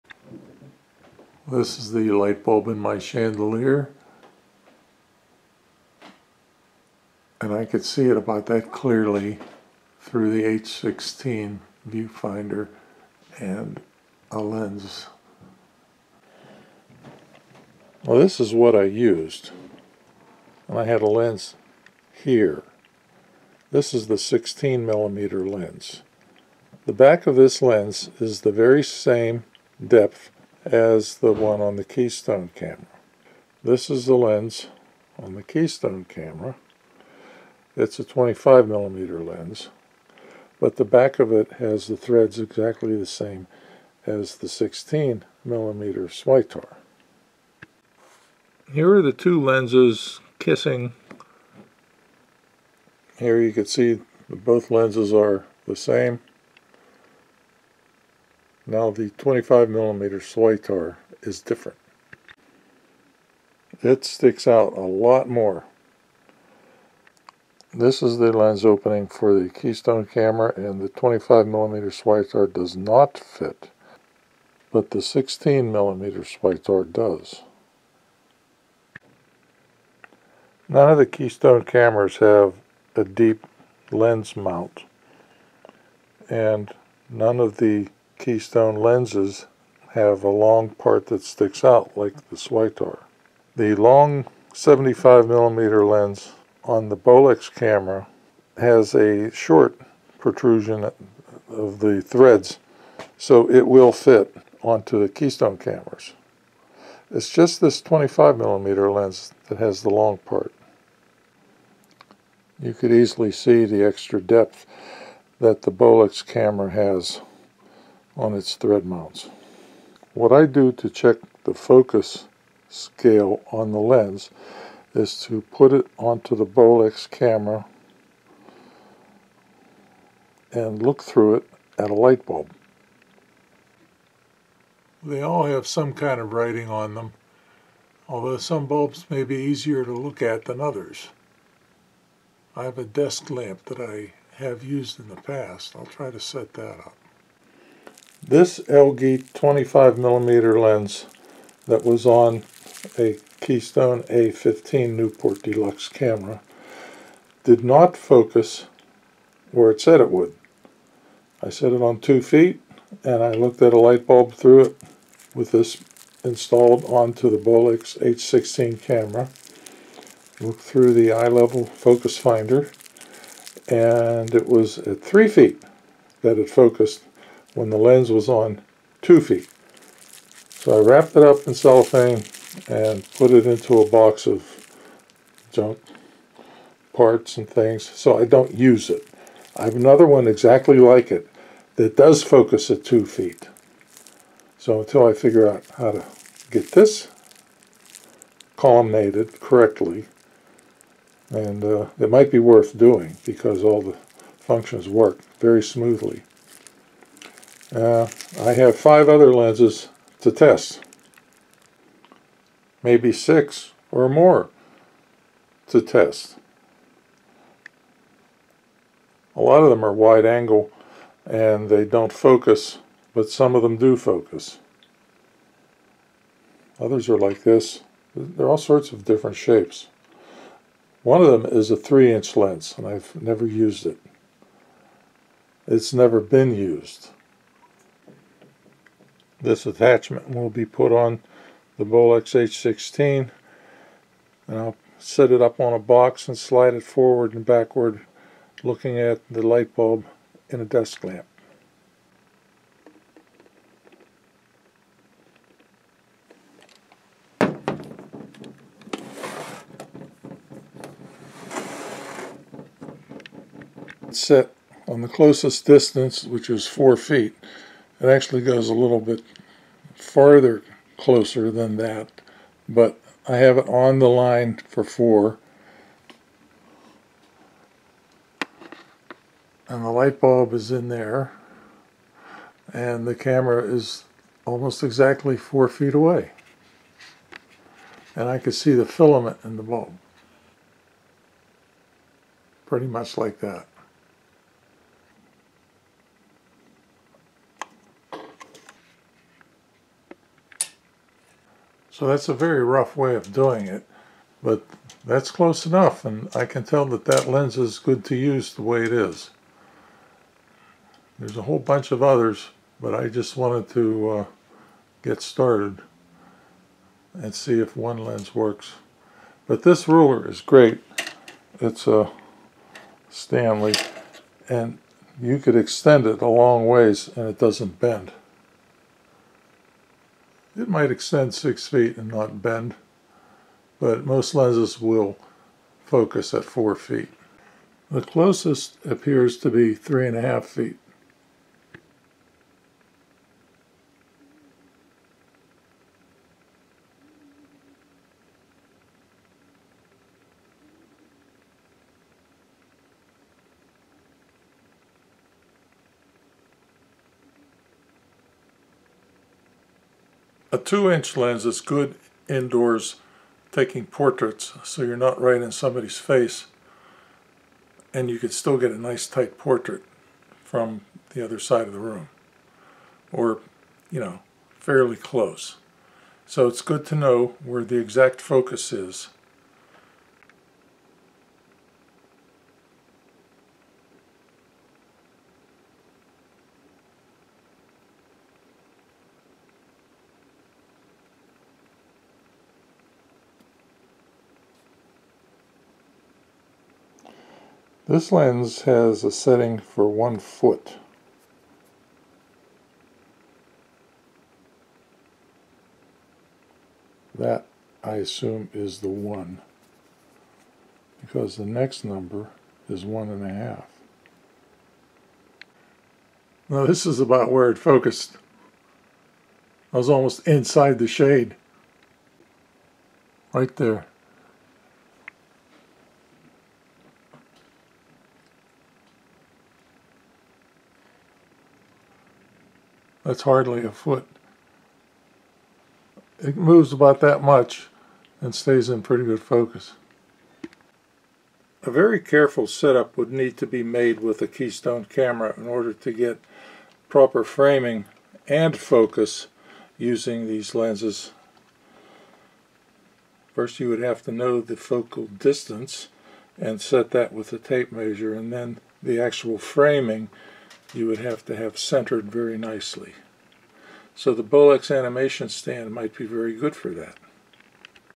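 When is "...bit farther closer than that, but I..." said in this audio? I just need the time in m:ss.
4:28.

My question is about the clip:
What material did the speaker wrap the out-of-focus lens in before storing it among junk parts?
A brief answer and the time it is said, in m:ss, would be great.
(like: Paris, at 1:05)
cellophane, at 3:01.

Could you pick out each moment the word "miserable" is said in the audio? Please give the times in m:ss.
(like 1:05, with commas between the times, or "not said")
not said.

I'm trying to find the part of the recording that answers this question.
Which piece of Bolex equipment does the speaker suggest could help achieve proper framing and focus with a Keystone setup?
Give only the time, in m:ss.
7:44.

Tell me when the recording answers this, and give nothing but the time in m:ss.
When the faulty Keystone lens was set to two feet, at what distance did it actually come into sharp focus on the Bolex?
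2:55.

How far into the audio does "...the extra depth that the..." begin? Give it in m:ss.
1:53.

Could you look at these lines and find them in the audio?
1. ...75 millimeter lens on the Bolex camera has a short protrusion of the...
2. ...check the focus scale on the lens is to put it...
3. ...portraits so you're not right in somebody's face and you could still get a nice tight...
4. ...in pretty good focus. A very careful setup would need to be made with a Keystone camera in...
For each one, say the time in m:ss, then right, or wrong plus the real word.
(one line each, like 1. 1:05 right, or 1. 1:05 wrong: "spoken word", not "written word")
1. 1:34 right
2. 2:00 right
3. 6:03 right
4. 7:18 right.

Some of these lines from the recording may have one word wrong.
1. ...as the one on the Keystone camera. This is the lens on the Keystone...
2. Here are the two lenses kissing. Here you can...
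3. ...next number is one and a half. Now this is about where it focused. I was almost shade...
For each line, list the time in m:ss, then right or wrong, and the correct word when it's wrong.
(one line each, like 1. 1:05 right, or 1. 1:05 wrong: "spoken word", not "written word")
1. 0:30 right
2. 0:48 right
3. 6:51 wrong: "inside", not "shade".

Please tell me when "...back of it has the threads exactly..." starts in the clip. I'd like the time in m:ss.
0:40.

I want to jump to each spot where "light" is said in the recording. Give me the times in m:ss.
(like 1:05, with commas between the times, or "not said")
0:02, 2:11, 2:43, 4:09, 4:39.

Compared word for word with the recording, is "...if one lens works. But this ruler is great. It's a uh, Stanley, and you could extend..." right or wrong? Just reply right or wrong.
right.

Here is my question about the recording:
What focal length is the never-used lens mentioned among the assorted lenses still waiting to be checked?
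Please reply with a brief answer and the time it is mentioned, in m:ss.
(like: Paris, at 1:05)
3 inch, at 3:51.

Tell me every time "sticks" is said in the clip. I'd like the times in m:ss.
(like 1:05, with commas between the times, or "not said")
1:04, 1:31.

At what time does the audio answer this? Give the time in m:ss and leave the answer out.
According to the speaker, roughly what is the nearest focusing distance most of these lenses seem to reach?
5:39.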